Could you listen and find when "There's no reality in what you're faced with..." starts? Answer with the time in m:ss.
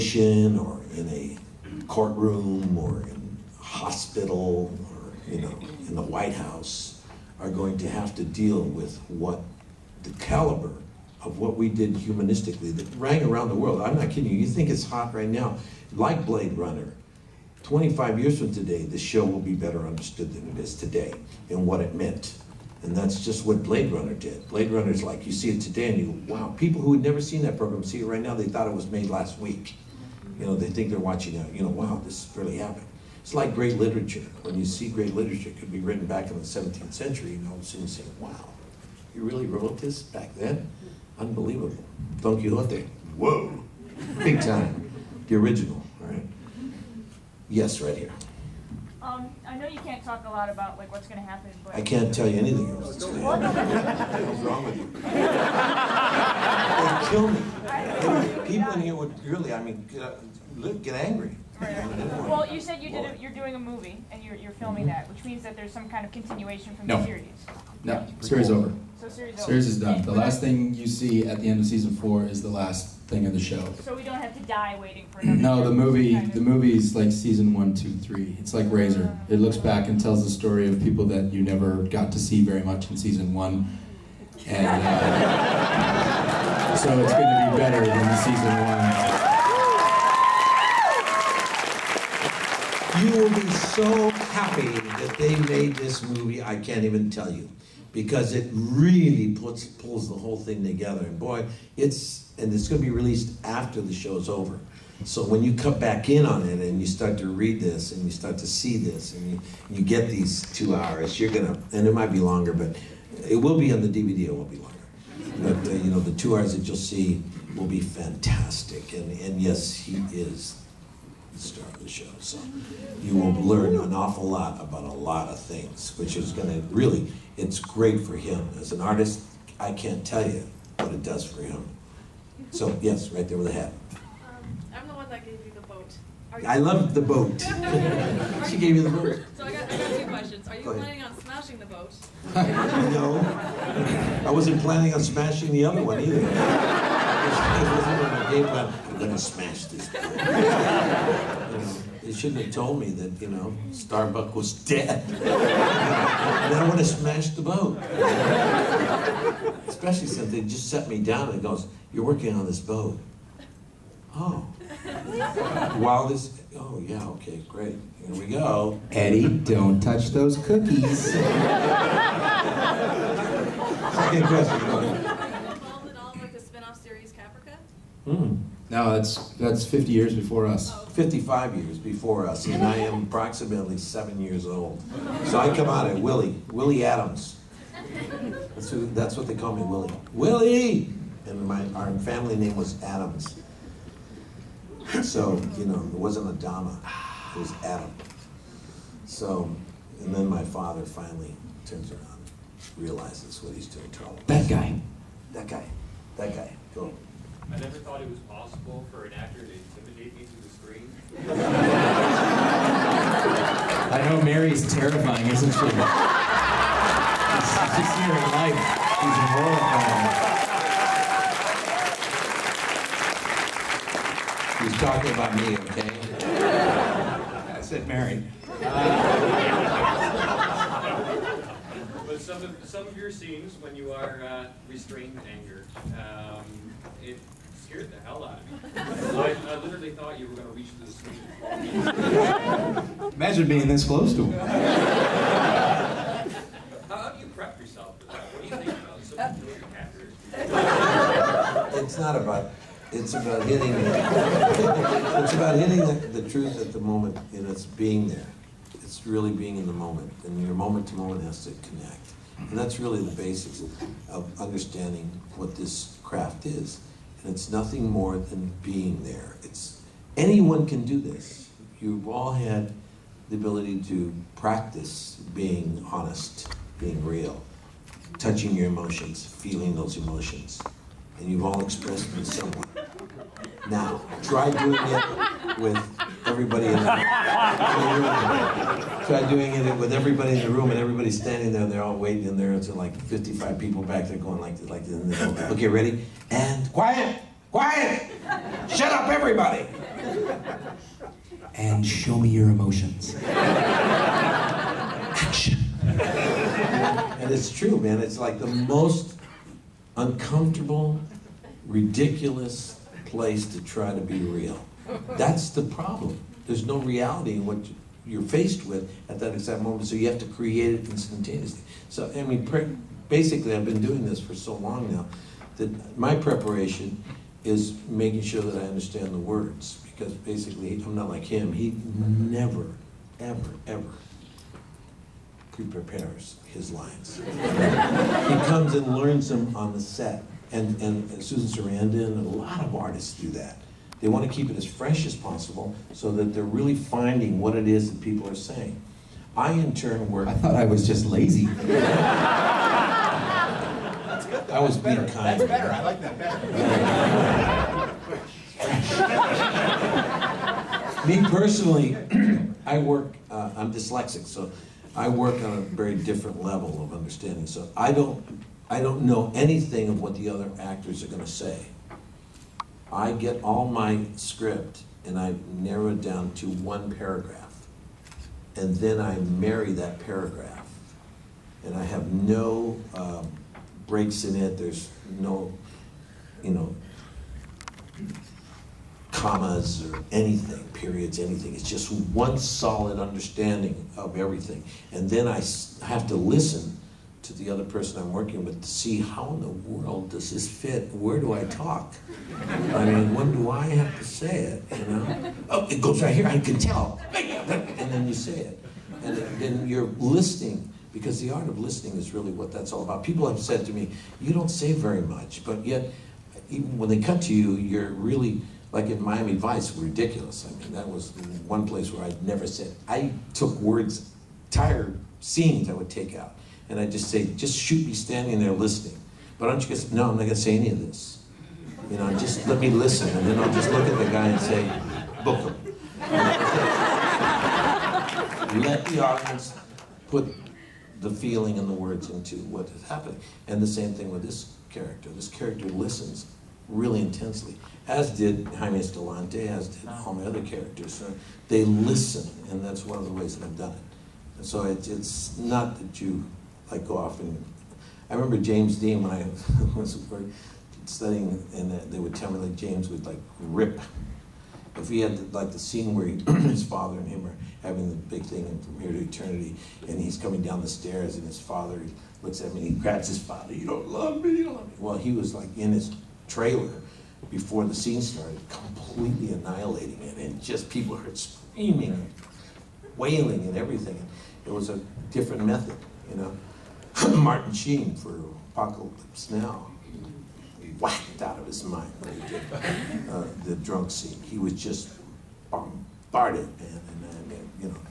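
5:16.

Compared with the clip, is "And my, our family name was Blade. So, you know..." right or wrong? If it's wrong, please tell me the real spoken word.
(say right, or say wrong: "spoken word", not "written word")
wrong: "Adams", not "Blade".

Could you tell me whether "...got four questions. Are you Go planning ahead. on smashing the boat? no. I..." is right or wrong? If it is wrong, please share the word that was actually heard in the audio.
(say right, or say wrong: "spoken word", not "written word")
wrong: "two", not "four".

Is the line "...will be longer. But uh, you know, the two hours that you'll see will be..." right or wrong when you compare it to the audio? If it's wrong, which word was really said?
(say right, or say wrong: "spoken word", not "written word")
right.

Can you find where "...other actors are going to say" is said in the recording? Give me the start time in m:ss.
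6:10.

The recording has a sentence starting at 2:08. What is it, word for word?
As an artist, I can't tell you what it does for him.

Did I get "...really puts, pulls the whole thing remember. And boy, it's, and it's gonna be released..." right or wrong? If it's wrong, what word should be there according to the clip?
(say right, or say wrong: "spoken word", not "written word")
wrong: "together", not "remember".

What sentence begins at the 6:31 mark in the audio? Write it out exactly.
It's just one solid understanding of everything.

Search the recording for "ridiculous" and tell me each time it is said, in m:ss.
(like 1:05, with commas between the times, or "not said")
5:11, 6:59.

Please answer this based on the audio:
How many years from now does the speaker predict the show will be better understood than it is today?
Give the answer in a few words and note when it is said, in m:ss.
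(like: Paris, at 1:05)
25, at 0:17.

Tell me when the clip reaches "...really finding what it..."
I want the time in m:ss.
5:46.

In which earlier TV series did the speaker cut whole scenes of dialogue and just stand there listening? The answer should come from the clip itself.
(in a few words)
Miami Vice.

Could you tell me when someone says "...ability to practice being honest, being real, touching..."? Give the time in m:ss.
4:33.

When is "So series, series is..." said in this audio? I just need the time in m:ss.
1:09.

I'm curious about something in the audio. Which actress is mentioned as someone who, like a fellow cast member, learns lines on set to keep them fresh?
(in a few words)
Susan Sarandon.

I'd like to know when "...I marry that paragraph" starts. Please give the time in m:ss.
6:18.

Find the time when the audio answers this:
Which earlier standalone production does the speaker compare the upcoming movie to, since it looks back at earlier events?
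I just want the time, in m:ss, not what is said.
1:18.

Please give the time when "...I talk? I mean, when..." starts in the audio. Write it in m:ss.
6:41.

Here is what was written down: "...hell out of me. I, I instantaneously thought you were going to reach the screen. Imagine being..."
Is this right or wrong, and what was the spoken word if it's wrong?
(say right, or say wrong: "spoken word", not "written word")
wrong: "literally", not "instantaneously".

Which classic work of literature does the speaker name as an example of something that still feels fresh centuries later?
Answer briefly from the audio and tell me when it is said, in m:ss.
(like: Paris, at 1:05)
Don Quixote, at 0:42.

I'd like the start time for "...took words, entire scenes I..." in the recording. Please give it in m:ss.
7:03.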